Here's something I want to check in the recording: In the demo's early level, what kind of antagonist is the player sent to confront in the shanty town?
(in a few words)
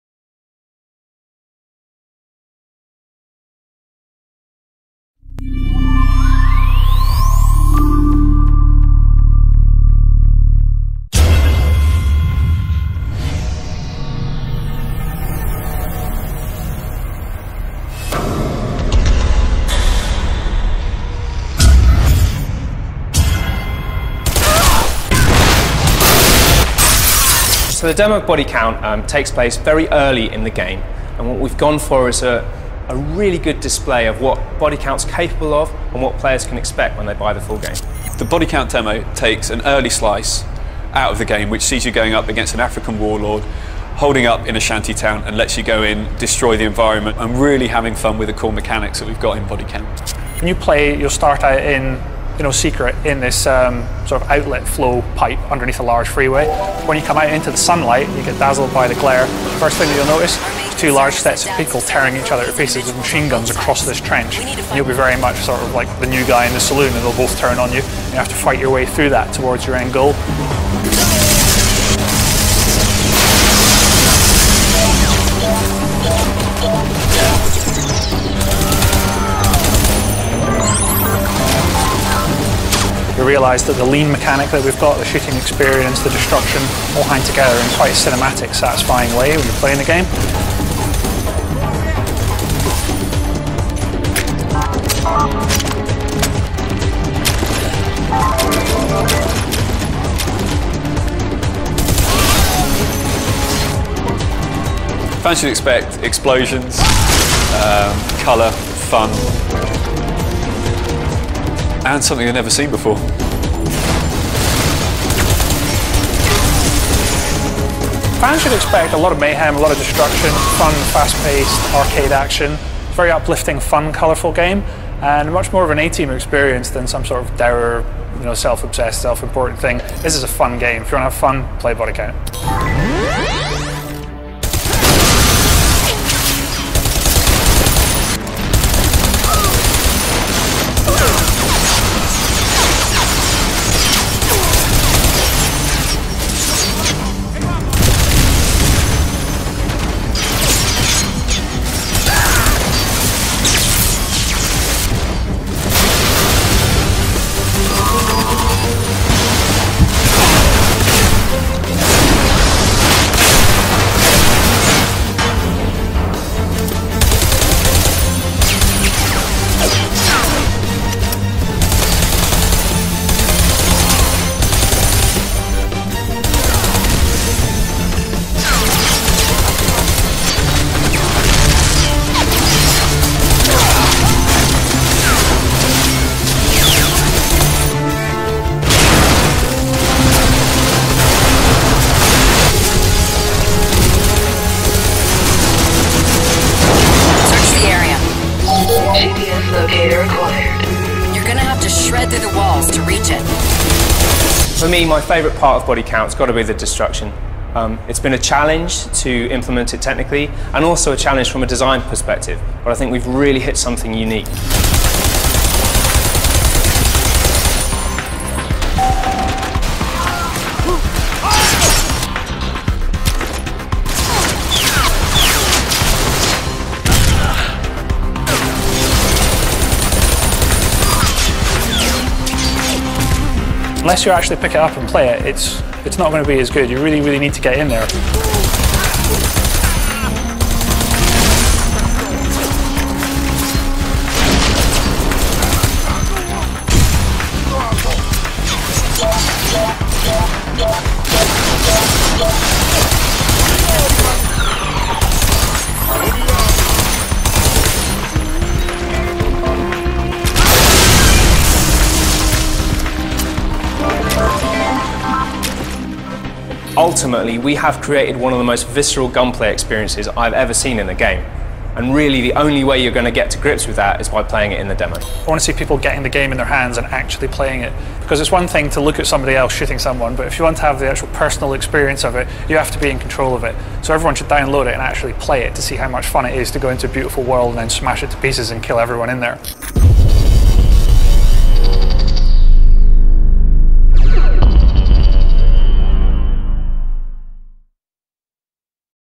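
African warlord.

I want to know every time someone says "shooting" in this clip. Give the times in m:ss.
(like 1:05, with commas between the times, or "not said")
1:25, 4:39.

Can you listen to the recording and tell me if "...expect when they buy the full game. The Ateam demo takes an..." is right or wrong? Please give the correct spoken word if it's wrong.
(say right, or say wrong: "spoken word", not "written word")
wrong: "Bodycount", not "Ateam".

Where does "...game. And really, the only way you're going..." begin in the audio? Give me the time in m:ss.
4:30.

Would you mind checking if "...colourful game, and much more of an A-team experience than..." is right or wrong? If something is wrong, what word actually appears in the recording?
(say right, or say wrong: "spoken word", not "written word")
right.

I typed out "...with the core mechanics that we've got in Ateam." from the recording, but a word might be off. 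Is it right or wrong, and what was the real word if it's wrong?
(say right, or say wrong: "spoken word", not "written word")
wrong: "Bodycount", not "Ateam".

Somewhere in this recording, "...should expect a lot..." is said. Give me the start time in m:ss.
1:58.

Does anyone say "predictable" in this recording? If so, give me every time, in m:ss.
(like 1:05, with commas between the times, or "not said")
not said.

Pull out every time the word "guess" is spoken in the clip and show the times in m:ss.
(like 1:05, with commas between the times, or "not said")
not said.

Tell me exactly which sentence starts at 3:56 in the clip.
You really, really need to get in there.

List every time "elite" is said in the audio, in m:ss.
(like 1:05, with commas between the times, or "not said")
not said.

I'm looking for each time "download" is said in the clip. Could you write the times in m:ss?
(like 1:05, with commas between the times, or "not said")
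4:44.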